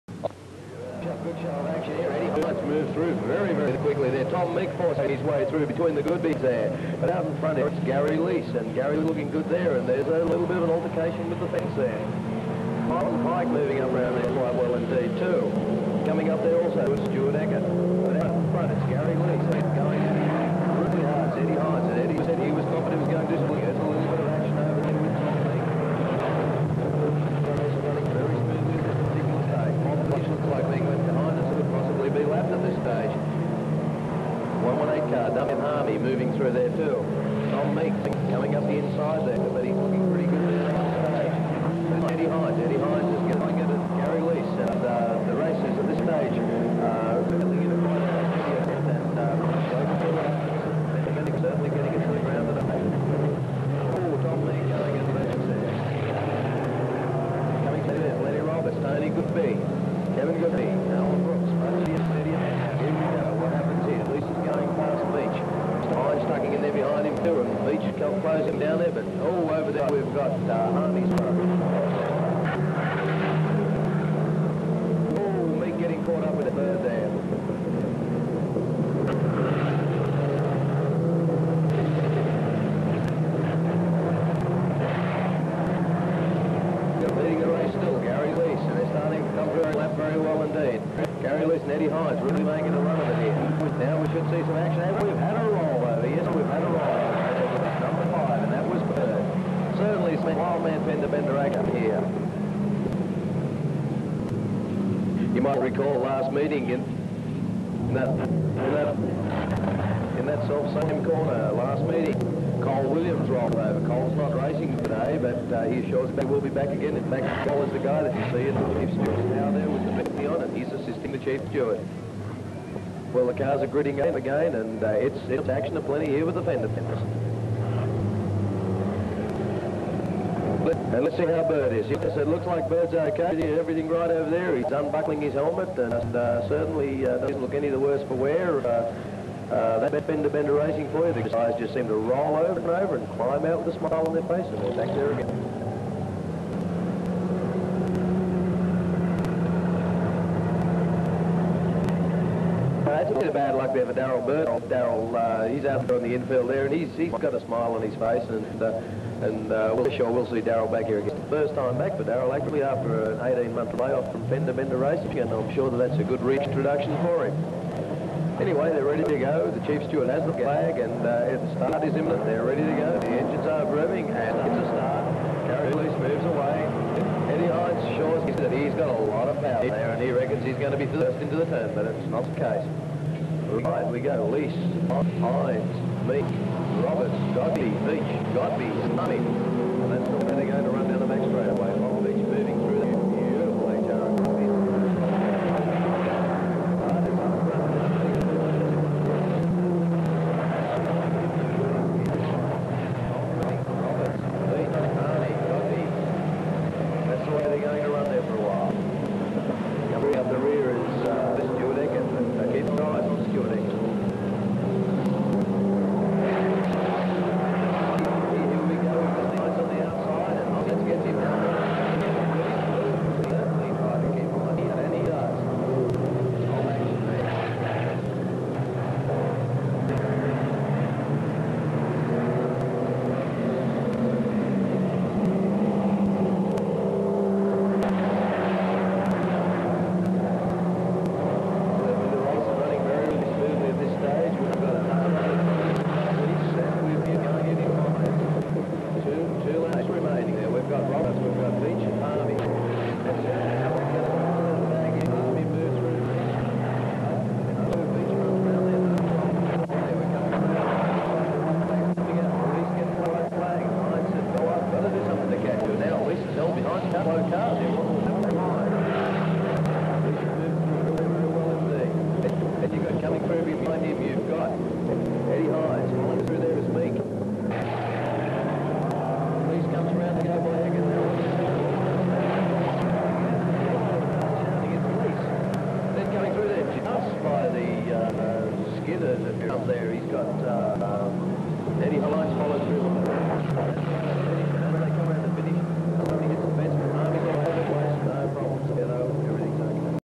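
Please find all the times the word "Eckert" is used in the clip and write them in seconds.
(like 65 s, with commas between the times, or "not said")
17 s.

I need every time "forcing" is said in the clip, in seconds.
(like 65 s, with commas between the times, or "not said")
4 s.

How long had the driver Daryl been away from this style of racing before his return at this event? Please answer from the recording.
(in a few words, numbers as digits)
18 months.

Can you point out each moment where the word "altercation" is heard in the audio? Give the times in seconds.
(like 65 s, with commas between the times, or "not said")
10 s.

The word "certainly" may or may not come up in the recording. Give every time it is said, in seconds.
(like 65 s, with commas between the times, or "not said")
51 s, 136 s.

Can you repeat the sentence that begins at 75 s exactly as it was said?
Oh, me getting caught up with the bird there.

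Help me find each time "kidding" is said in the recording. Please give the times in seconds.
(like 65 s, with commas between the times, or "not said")
not said.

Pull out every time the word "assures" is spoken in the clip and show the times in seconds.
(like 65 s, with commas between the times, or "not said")
115 s.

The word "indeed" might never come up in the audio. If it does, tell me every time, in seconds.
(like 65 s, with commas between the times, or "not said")
14 s, 90 s.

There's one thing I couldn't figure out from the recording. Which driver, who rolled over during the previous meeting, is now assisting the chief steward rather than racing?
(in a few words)
Cole Williams.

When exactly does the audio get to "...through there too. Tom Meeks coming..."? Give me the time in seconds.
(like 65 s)
36 s.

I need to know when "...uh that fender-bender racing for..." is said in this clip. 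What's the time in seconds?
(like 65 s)
139 s.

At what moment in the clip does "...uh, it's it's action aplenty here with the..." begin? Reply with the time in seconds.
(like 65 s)
124 s.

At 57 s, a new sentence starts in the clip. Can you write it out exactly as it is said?
Coming to there, Lenny Roberts, Tony Goodby, Kevin Goodby.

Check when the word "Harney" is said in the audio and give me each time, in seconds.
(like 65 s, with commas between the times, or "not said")
70 s.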